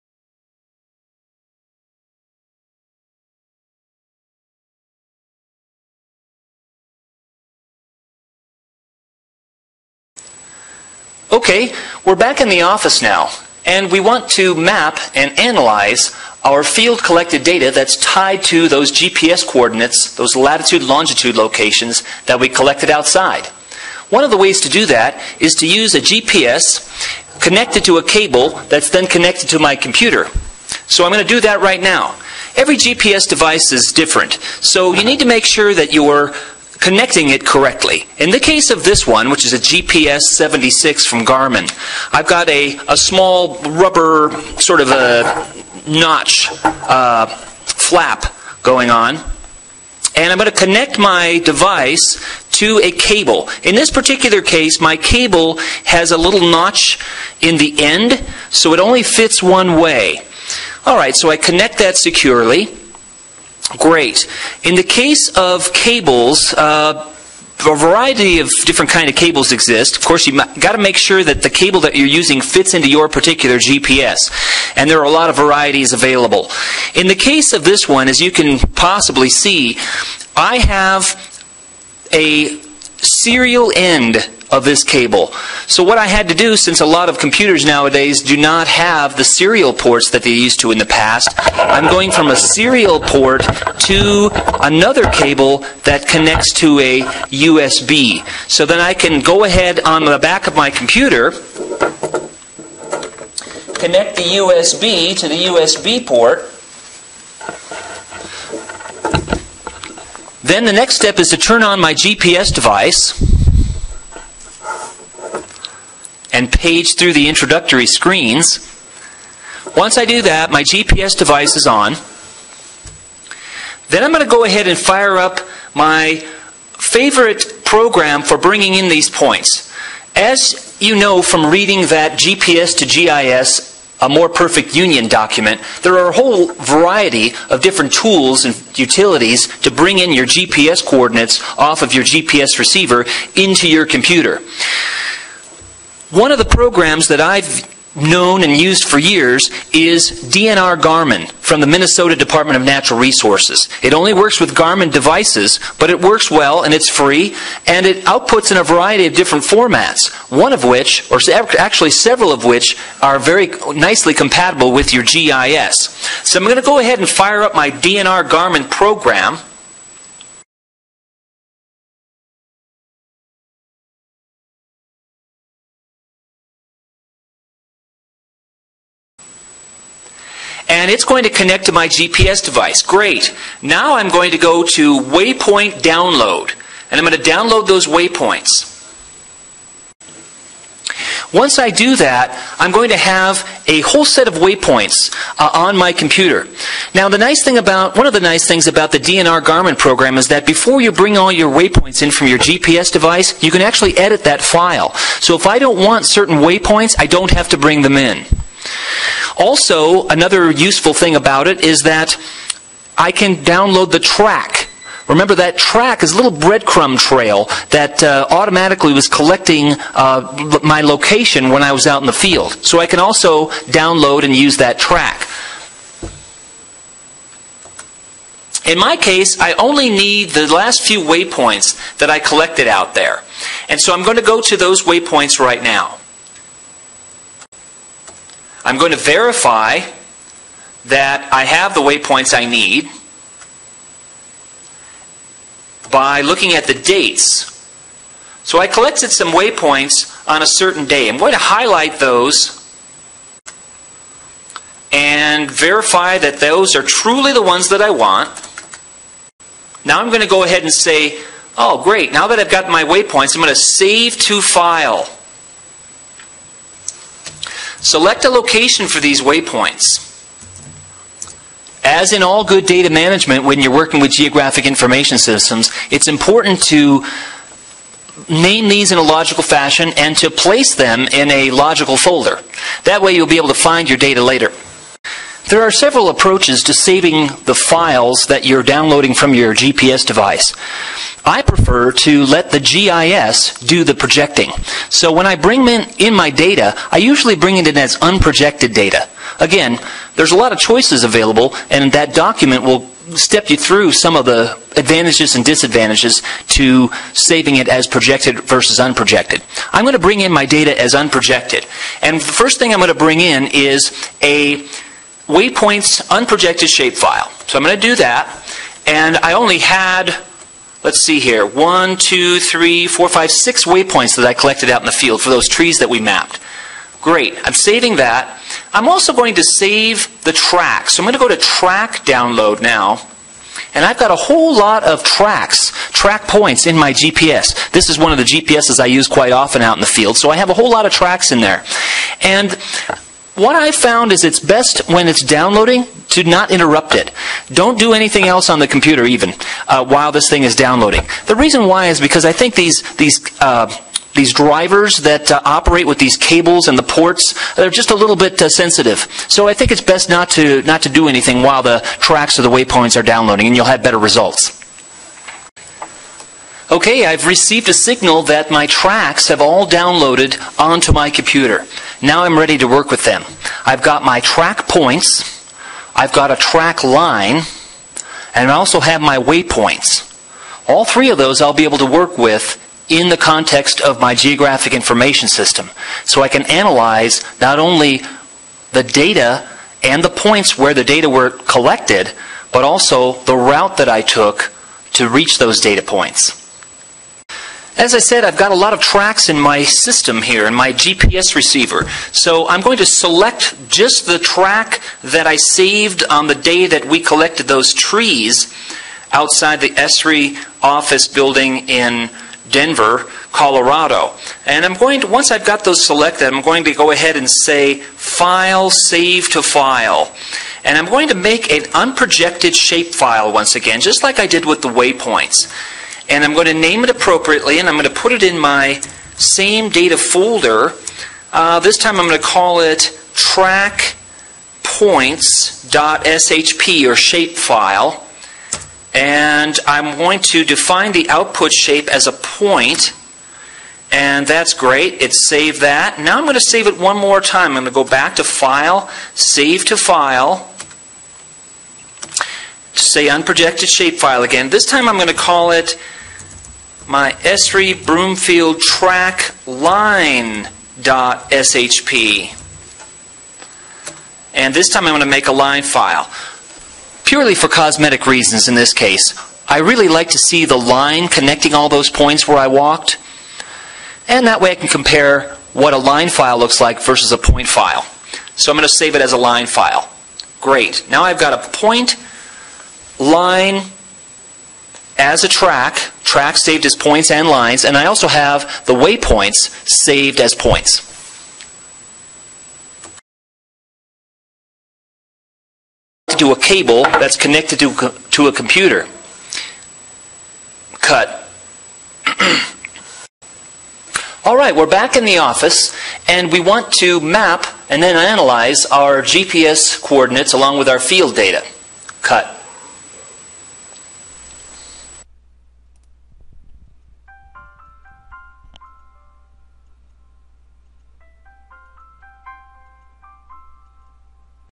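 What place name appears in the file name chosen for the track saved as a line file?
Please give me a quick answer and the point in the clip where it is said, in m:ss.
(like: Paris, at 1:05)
Broomfield, at 7:37.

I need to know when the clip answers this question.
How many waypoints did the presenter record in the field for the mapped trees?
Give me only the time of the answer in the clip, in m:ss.
5:23.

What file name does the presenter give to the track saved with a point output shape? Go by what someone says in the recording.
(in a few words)
track points.shp.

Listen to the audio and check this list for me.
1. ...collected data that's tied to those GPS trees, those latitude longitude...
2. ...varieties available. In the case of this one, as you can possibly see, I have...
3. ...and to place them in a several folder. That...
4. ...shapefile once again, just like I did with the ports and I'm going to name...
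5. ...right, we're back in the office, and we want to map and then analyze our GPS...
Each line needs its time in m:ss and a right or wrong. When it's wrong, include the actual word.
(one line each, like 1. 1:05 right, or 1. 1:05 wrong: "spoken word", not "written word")
1. 0:17 wrong: "coordinates", not "trees"
2. 1:15 right
3. 4:39 wrong: "logical", not "several"
4. 7:02 wrong: "waypoints", not "ports"
5. 8:24 right.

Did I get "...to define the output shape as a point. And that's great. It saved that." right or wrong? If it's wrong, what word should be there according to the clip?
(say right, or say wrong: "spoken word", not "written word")
right.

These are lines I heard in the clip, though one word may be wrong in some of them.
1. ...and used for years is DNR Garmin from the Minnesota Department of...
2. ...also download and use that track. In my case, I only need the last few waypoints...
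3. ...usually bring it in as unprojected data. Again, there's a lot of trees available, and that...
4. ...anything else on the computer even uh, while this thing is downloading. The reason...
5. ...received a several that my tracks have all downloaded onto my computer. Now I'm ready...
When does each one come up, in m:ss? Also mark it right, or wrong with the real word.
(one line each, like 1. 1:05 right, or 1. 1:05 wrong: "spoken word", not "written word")
1. 2:28 right
2. 3:42 right
3. 4:56 wrong: "choices", not "trees"
4. 5:47 right
5. 6:07 wrong: "signal", not "several".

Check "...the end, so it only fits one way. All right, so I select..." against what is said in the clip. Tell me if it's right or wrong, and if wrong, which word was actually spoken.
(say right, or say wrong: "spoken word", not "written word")
wrong: "connect", not "select".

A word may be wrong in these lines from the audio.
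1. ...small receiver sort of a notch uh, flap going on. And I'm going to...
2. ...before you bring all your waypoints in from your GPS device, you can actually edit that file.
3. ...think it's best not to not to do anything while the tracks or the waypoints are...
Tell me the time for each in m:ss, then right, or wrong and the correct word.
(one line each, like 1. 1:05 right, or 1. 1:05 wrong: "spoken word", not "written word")
1. 0:42 wrong: "rubber", not "receiver"
2. 3:20 right
3. 5:59 right.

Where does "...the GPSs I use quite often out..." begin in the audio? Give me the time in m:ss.
5:38.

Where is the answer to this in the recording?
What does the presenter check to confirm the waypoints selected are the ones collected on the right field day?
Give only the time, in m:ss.
4:06.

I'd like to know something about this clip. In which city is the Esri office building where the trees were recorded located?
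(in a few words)
Denver.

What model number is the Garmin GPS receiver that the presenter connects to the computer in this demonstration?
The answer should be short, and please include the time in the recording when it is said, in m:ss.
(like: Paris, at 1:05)
GPS 76, at 0:39.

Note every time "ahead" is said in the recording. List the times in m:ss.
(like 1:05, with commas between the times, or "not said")
1:39, 2:04, 2:46, 4:20, 6:56.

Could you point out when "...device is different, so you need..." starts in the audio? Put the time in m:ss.
0:33.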